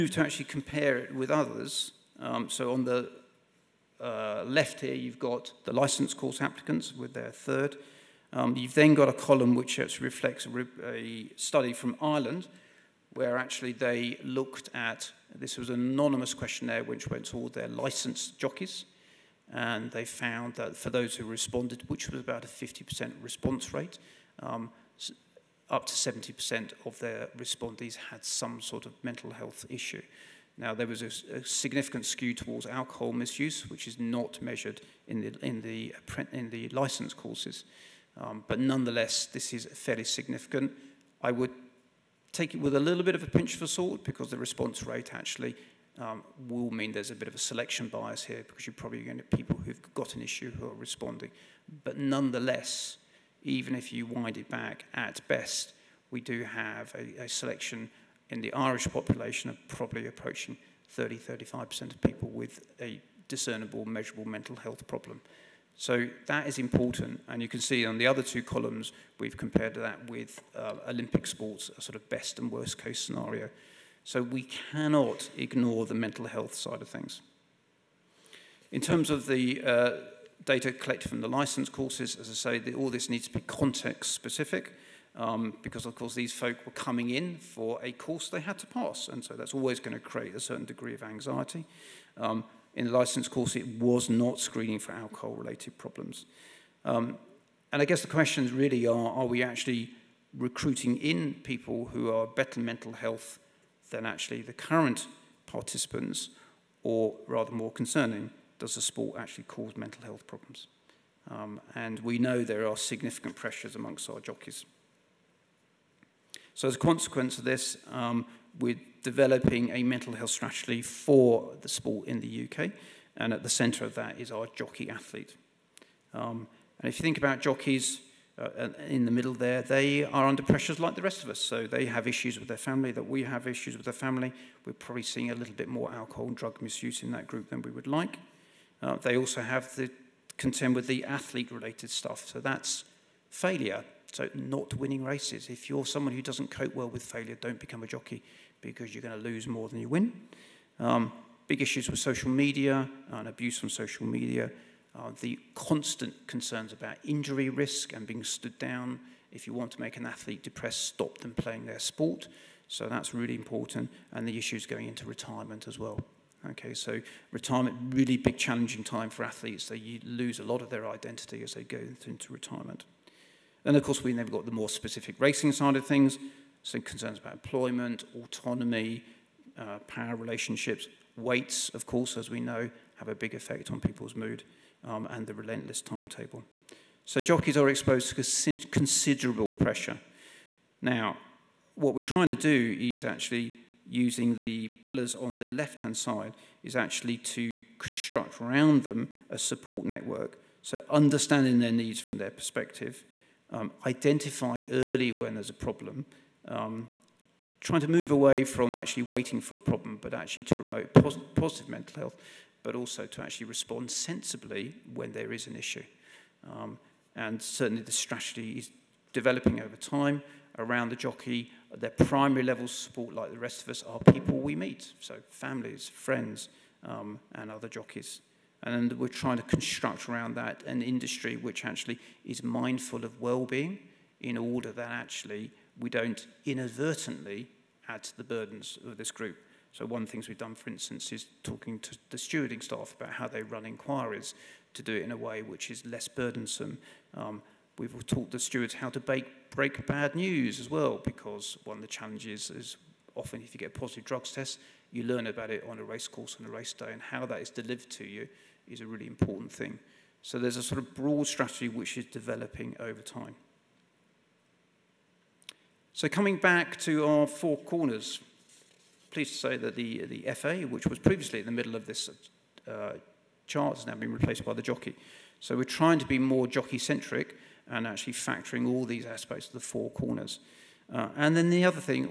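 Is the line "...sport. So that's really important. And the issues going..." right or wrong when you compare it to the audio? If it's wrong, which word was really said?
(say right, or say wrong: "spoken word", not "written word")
right.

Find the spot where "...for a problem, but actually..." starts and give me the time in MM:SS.
03:29.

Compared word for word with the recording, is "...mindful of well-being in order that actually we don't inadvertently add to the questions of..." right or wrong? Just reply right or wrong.
wrong.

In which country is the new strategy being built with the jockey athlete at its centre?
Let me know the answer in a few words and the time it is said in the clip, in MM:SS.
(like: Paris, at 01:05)
UK, at 02:02.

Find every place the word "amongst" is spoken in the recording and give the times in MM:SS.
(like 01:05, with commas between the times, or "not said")
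01:53.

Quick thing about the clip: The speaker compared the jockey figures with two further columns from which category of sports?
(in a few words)
Olympic sports.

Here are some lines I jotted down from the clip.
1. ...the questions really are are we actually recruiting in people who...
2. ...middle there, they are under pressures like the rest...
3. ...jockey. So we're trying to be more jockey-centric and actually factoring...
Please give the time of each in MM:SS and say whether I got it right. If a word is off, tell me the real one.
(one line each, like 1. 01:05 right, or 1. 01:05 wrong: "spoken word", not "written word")
1. 01:38 right
2. 02:09 right
3. 04:34 right.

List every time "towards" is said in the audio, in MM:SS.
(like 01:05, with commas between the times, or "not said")
00:32.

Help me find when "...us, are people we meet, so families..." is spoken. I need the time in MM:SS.
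03:43.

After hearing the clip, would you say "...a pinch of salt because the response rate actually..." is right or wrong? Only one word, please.
right.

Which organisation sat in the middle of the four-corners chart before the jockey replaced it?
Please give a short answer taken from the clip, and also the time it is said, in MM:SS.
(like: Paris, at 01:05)
The FA, at 04:30.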